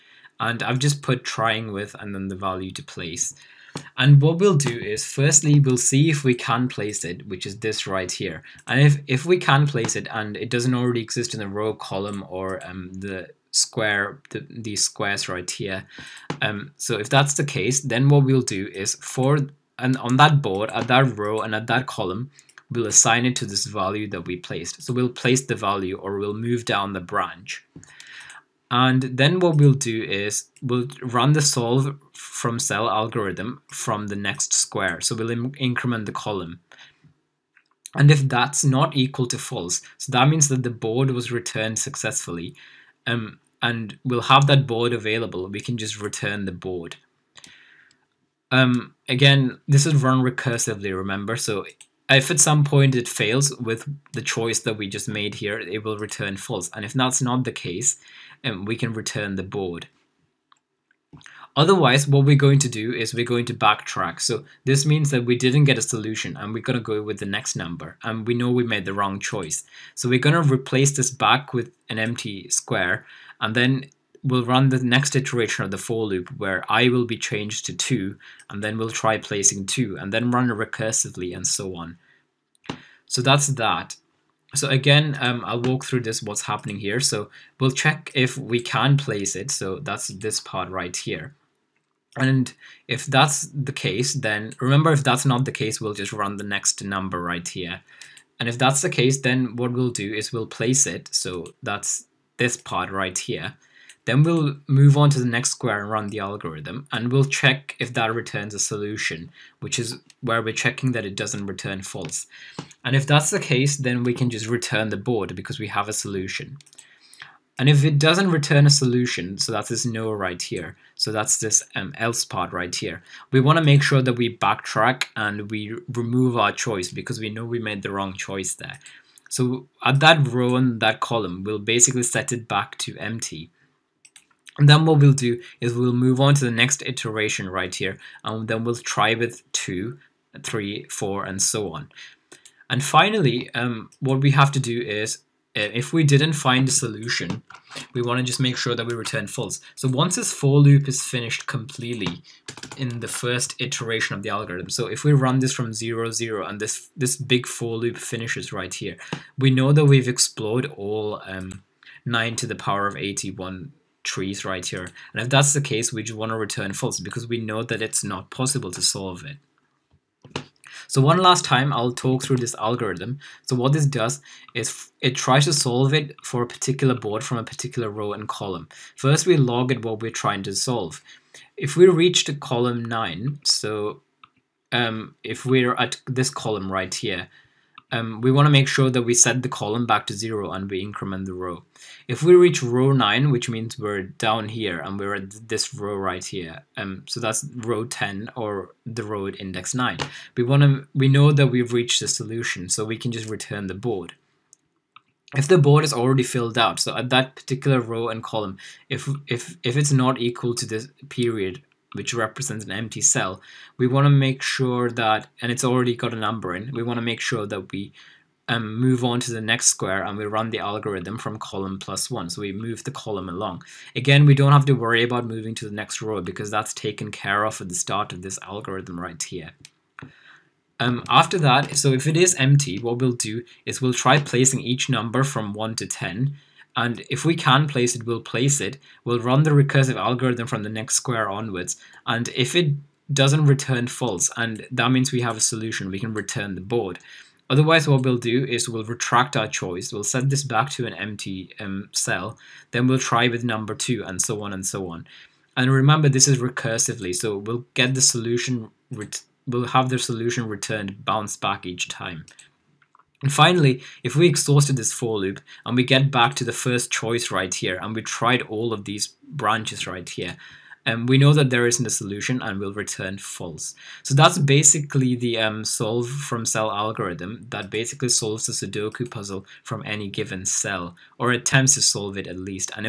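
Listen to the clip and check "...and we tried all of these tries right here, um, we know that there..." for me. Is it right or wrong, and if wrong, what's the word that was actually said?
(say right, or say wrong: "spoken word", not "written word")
wrong: "branches", not "tries".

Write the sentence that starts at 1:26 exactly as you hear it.
So we'll check if we can place it.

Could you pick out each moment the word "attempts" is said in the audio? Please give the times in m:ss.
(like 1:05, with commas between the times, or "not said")
4:41.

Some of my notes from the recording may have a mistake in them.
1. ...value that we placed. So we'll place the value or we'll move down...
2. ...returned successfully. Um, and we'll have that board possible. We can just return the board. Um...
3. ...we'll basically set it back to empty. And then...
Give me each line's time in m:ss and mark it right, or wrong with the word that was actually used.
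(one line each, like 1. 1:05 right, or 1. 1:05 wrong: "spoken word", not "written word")
1. 0:23 right
2. 0:41 wrong: "available", not "possible"
3. 2:11 right.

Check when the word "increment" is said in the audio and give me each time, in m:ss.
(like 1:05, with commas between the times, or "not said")
0:35, 3:10.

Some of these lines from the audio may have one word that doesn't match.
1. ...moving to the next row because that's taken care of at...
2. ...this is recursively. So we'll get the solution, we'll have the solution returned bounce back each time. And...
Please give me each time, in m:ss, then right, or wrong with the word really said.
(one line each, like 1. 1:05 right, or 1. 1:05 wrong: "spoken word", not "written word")
1. 3:45 right
2. 4:16 right.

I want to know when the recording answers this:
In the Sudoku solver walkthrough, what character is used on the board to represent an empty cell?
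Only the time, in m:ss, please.
3:31.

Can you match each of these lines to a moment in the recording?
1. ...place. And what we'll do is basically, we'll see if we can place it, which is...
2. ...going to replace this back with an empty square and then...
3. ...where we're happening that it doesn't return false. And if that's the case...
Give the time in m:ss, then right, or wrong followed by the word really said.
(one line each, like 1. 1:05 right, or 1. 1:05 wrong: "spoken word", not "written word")
1. 0:02 wrong: "firstly", not "basically"
2. 1:10 right
3. 1:50 wrong: "checking", not "happening".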